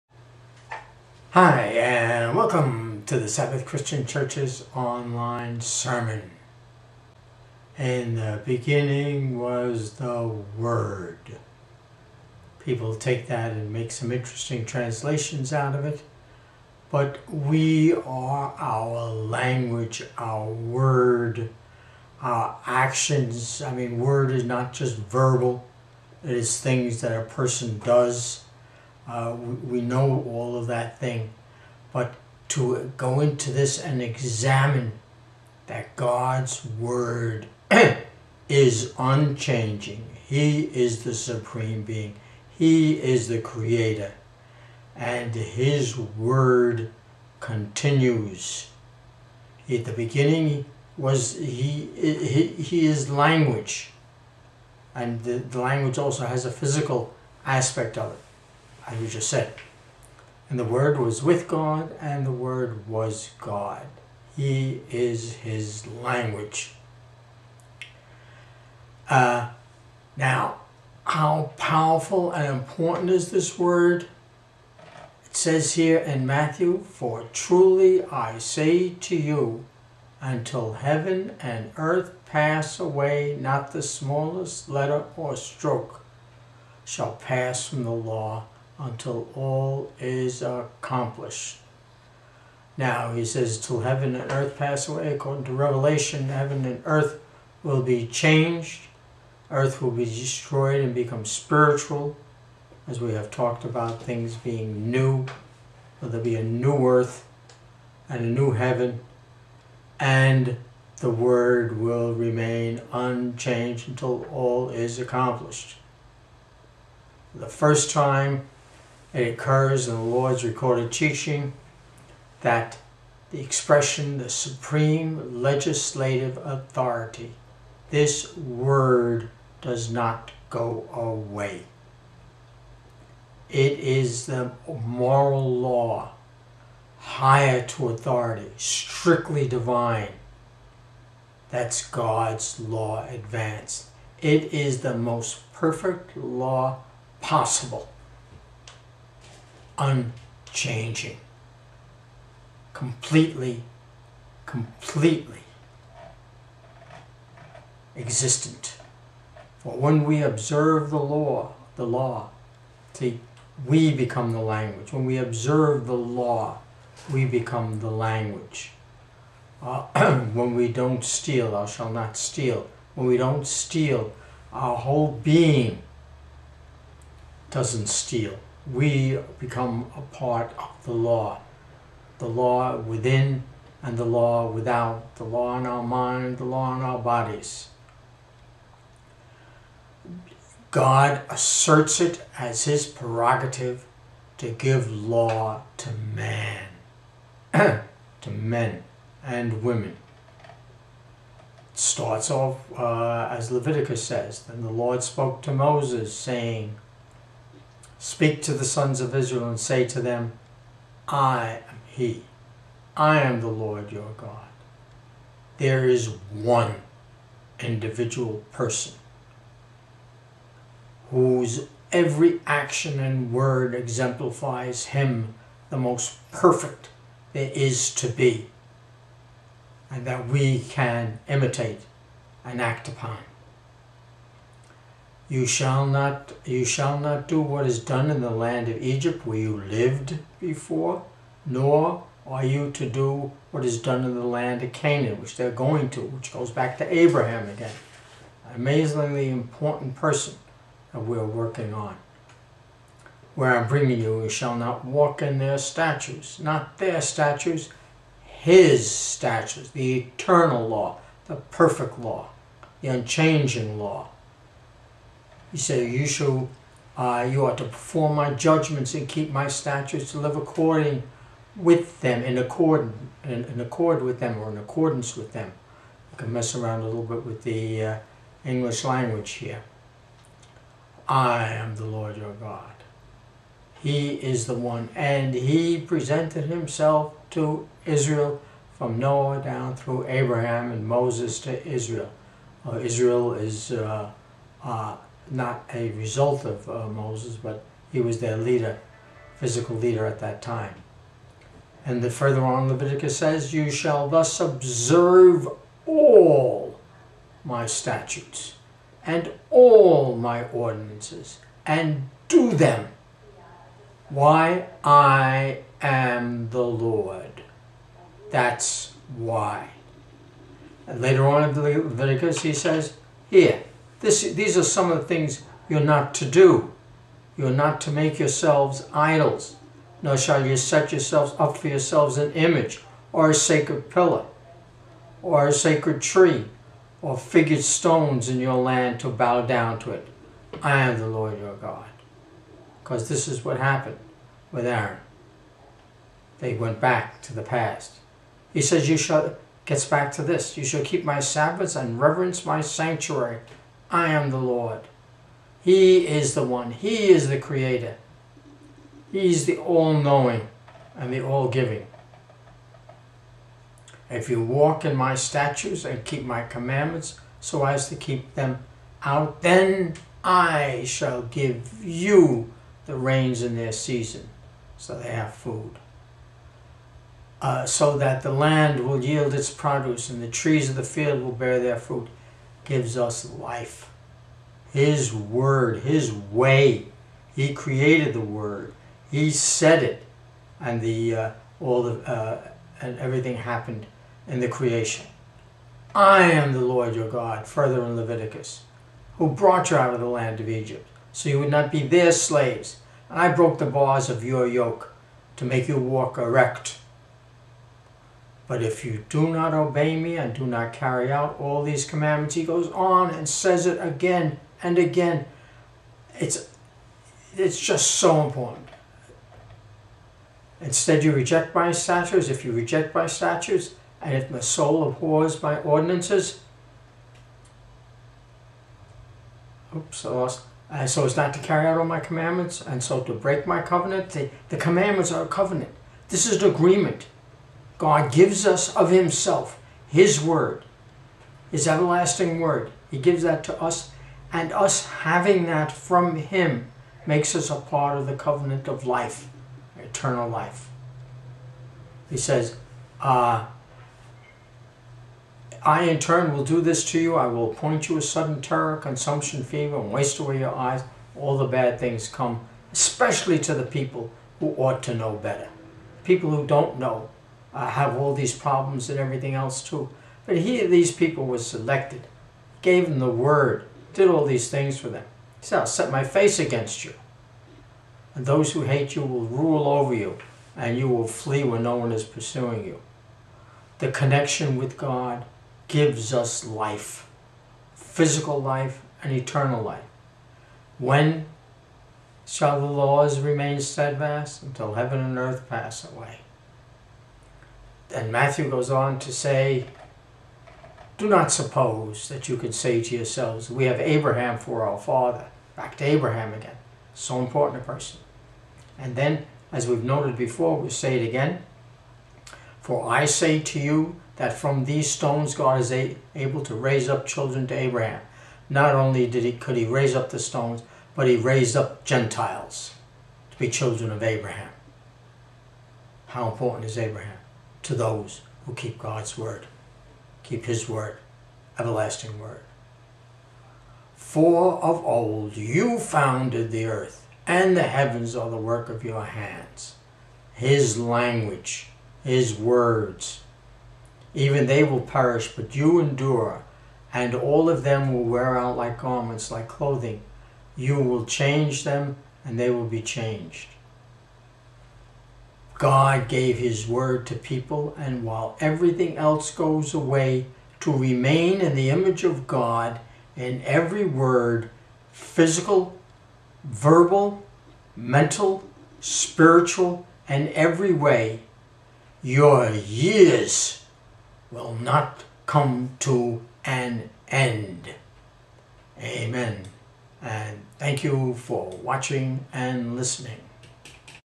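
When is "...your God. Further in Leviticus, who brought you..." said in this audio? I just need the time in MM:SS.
06:36.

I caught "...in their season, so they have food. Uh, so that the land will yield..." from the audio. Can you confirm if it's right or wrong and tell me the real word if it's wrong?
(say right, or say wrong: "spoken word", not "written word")
right.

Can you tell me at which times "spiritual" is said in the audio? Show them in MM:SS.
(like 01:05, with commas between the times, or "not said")
01:41, 09:28.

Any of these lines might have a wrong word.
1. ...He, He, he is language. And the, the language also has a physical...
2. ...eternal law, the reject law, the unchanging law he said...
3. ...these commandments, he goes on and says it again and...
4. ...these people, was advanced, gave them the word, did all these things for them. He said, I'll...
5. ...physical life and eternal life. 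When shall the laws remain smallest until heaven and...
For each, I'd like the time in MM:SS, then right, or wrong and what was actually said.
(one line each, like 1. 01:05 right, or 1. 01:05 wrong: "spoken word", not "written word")
1. 00:51 right
2. 04:19 wrong: "perfect", not "reject"
3. 06:51 right
4. 07:50 wrong: "selected", not "advanced"
5. 08:07 wrong: "steadfast", not "smallest".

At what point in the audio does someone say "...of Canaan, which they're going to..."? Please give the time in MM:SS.
04:04.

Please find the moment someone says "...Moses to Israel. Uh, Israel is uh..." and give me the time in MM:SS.
04:50.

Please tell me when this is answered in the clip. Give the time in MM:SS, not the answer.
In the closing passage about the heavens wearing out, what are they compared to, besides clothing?
09:08.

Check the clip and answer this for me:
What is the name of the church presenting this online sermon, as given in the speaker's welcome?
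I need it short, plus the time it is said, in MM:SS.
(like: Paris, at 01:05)
Sabbath Christian Church, at 00:03.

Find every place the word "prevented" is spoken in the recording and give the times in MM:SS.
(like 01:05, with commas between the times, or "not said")
not said.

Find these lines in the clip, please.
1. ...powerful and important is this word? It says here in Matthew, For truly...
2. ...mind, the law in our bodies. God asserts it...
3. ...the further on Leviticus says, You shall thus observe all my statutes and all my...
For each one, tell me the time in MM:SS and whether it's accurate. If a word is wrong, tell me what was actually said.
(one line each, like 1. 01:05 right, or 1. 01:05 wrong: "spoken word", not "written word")
1. 01:11 right
2. 03:05 right
3. 05:02 right.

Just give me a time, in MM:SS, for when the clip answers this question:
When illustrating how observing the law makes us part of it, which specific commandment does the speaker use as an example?
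02:51.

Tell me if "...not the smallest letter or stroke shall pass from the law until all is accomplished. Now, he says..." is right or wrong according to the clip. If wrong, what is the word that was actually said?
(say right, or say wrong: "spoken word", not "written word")
right.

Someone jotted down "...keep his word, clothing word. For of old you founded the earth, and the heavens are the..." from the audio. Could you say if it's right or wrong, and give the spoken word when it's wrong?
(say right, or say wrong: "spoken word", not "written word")
wrong: "everlasting", not "clothing".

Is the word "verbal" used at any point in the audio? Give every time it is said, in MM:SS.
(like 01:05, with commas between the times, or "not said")
00:24, 09:26.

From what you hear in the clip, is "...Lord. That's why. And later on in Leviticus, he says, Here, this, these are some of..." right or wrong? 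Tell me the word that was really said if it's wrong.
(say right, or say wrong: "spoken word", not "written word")
right.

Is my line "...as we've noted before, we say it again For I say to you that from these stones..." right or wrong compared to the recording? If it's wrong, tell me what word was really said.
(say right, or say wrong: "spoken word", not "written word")
right.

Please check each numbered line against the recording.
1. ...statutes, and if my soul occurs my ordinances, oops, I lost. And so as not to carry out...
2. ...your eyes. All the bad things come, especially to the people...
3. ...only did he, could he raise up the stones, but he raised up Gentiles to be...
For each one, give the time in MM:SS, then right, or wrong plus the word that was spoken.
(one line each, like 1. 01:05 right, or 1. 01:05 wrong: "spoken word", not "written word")
1. 07:03 wrong: "abhors", not "occurs"
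2. 07:40 right
3. 08:38 right.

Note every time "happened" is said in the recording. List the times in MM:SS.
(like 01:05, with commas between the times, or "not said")
05:43, 06:33.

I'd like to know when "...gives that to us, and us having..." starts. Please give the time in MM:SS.
07:22.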